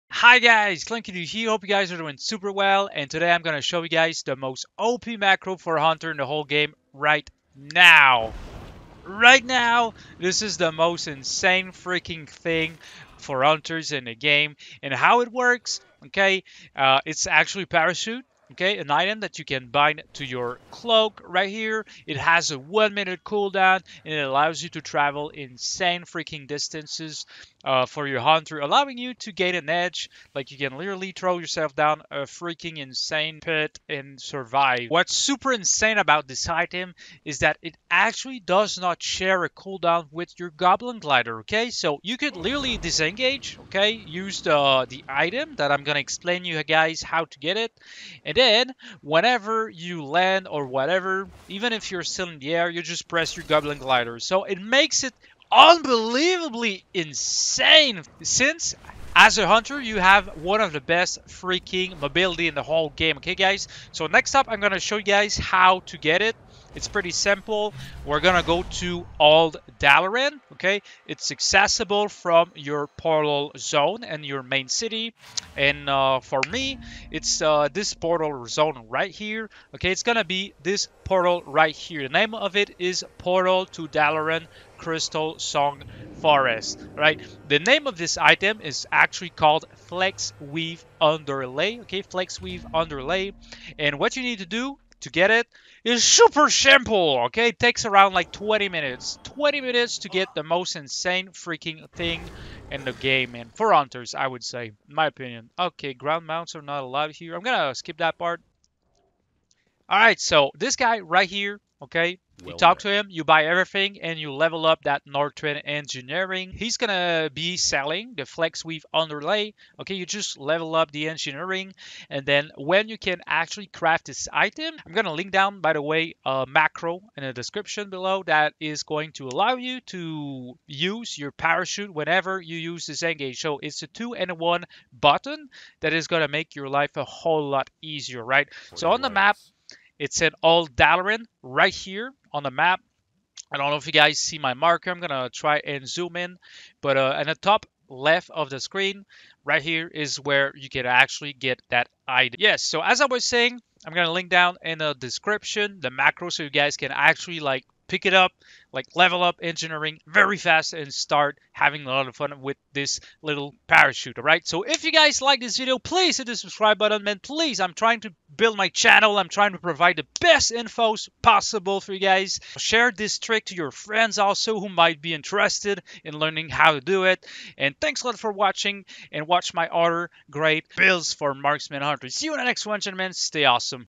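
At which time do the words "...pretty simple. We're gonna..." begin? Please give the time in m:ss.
1:06.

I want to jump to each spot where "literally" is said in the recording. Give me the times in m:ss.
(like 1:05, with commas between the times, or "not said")
0:30, 0:42.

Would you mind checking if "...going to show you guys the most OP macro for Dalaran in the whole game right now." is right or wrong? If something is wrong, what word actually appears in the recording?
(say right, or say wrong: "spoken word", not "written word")
wrong: "Hunter", not "Dalaran".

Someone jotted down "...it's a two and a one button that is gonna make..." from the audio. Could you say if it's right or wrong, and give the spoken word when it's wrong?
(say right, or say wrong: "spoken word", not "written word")
right.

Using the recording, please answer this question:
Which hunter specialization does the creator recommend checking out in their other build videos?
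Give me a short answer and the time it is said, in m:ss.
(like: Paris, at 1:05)
Marksman, at 3:01.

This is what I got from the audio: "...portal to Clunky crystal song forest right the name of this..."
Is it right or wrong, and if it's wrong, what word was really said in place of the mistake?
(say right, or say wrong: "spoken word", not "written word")
wrong: "Dalaran", not "Clunky".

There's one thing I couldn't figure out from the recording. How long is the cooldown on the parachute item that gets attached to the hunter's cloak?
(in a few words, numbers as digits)
1 minute.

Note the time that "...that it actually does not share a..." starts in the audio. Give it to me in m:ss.
0:37.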